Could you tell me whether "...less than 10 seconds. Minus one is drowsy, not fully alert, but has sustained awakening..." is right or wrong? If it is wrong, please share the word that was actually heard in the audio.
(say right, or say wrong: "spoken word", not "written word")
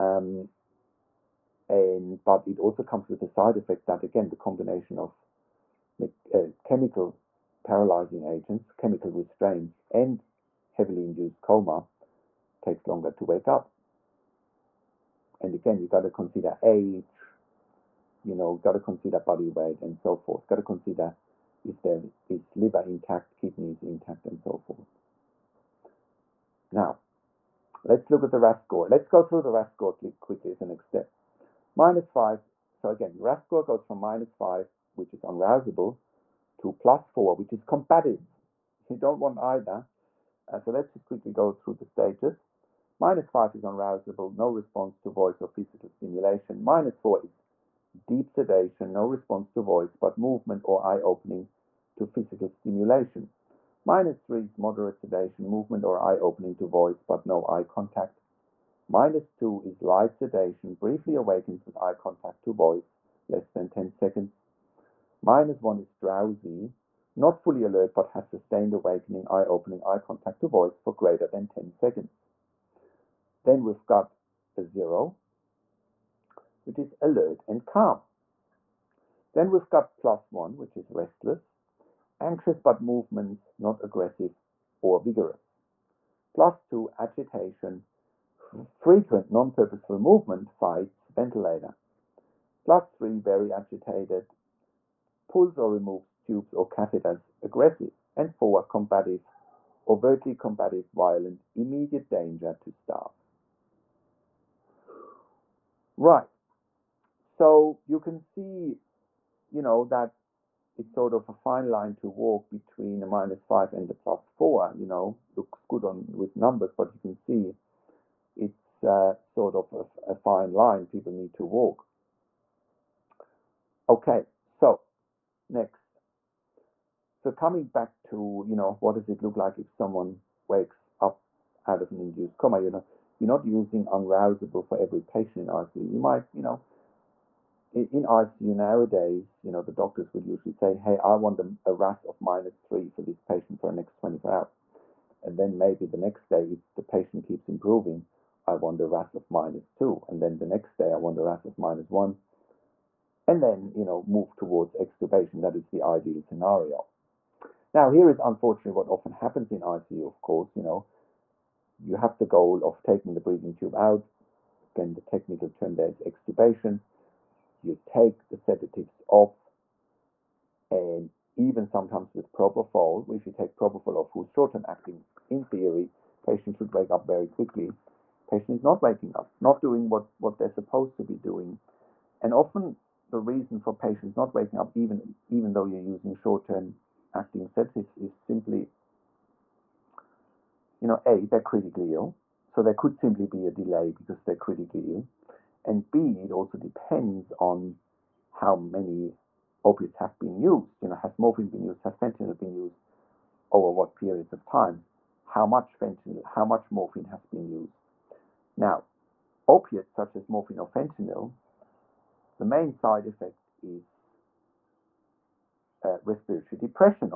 right.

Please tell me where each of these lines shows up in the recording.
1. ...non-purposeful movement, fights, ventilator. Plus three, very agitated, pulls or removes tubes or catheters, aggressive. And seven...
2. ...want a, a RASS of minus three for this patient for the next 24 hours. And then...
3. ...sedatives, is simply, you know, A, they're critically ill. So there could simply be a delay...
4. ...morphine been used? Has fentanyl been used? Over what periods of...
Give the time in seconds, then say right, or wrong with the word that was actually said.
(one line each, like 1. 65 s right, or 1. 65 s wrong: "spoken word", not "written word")
1. 89 s wrong: "four", not "seven"
2. 141 s right
3. 187 s right
4. 201 s right.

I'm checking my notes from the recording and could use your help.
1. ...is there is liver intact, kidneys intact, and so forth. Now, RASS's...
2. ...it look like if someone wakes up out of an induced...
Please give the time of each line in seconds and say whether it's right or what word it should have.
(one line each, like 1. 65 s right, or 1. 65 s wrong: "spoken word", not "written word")
1. 21 s wrong: "Let", not "RASS"
2. 129 s right.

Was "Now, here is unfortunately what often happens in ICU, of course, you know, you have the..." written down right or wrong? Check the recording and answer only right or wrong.
right.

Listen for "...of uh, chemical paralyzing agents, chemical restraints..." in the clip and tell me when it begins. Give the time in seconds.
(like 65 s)
4 s.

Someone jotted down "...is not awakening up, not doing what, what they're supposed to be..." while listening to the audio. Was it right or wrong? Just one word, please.
wrong.